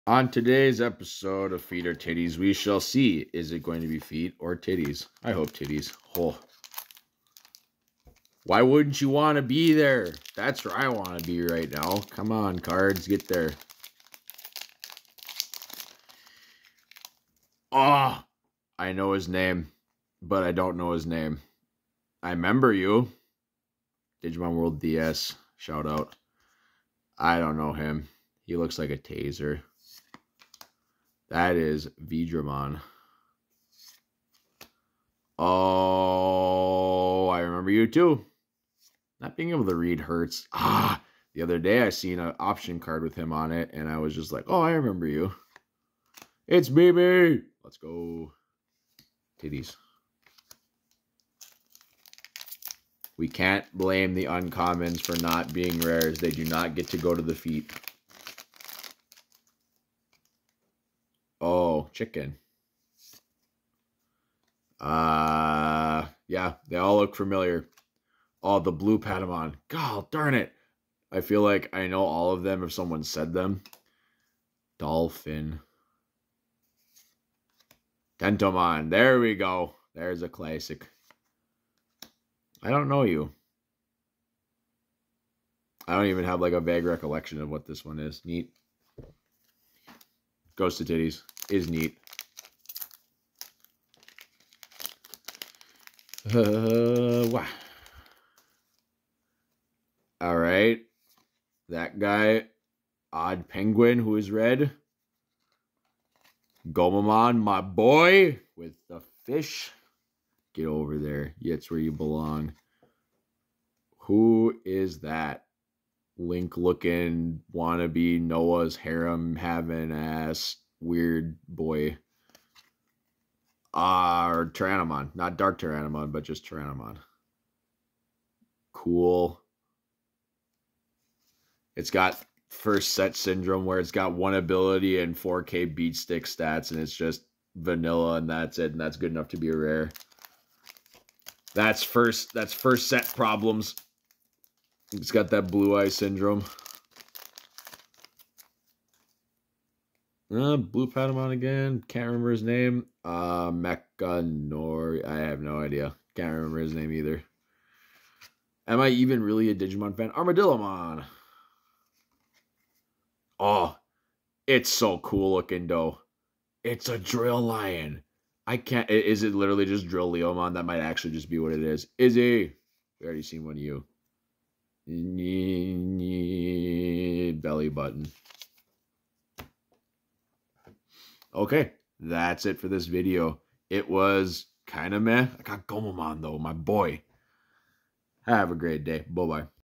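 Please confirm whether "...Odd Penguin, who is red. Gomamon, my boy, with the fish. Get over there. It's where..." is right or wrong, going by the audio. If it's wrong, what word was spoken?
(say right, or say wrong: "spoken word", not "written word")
right.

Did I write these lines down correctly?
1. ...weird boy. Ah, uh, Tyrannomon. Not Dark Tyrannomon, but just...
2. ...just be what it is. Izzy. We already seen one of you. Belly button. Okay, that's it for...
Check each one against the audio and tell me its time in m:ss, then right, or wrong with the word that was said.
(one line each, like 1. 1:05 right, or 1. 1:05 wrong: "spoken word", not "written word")
1. 2:00 right
2. 2:51 right.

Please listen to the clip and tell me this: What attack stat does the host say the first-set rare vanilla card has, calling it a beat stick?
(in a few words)
4K.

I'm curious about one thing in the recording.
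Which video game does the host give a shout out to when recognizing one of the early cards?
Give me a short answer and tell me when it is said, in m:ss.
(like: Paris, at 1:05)
Digimon World DS, at 0:24.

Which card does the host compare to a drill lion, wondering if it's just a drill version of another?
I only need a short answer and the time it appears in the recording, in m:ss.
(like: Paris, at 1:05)
Armadillomon, at 2:40.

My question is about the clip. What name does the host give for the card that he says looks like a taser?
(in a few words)
Veedramon.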